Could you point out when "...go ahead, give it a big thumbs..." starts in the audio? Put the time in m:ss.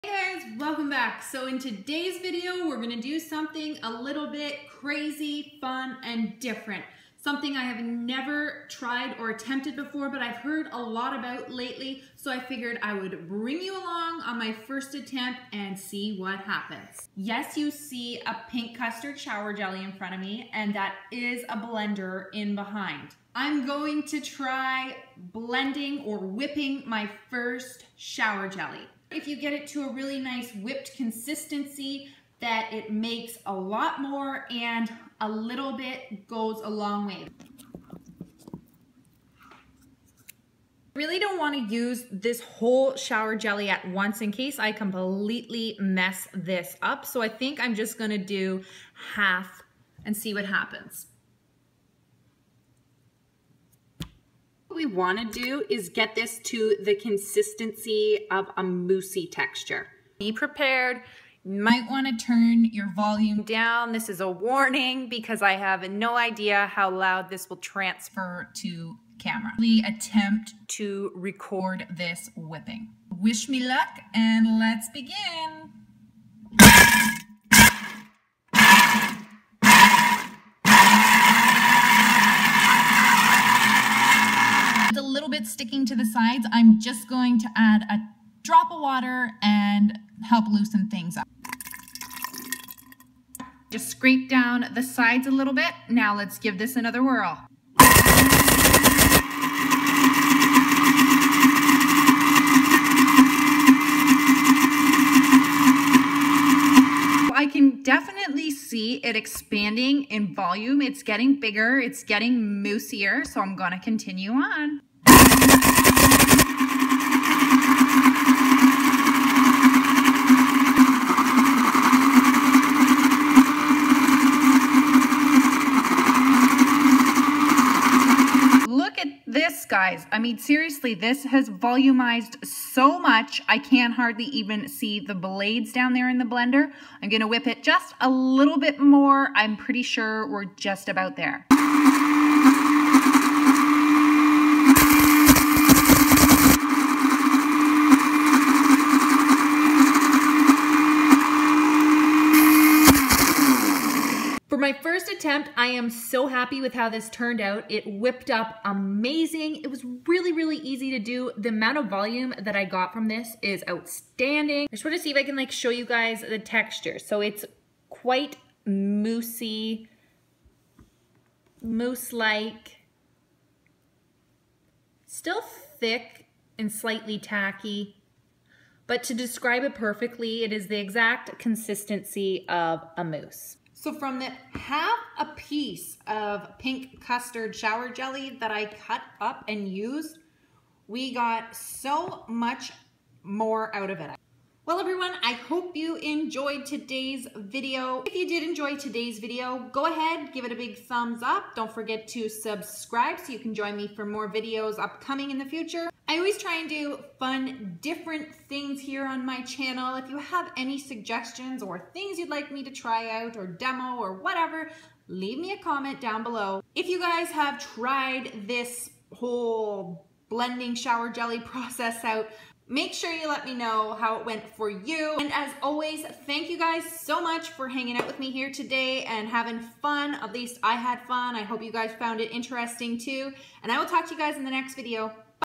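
3:19.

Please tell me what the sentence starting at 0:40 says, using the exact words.
Really don't want to use this whole shower jelly at once in case I completely mess this up.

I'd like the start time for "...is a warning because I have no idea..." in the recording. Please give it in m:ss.
1:04.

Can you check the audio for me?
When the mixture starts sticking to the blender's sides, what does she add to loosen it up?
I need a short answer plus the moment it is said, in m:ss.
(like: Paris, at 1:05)
a drop of water, at 1:27.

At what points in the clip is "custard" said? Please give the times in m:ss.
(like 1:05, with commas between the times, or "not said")
0:18, 3:07.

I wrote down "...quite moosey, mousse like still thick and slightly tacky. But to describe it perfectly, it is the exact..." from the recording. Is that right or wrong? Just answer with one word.
right.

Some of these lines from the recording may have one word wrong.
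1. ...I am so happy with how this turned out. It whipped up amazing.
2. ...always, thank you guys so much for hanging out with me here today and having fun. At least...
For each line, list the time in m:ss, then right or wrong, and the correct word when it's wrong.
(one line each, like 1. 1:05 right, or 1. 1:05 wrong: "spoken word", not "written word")
1. 2:35 right
2. 3:45 right.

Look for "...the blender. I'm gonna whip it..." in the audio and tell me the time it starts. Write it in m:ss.
2:16.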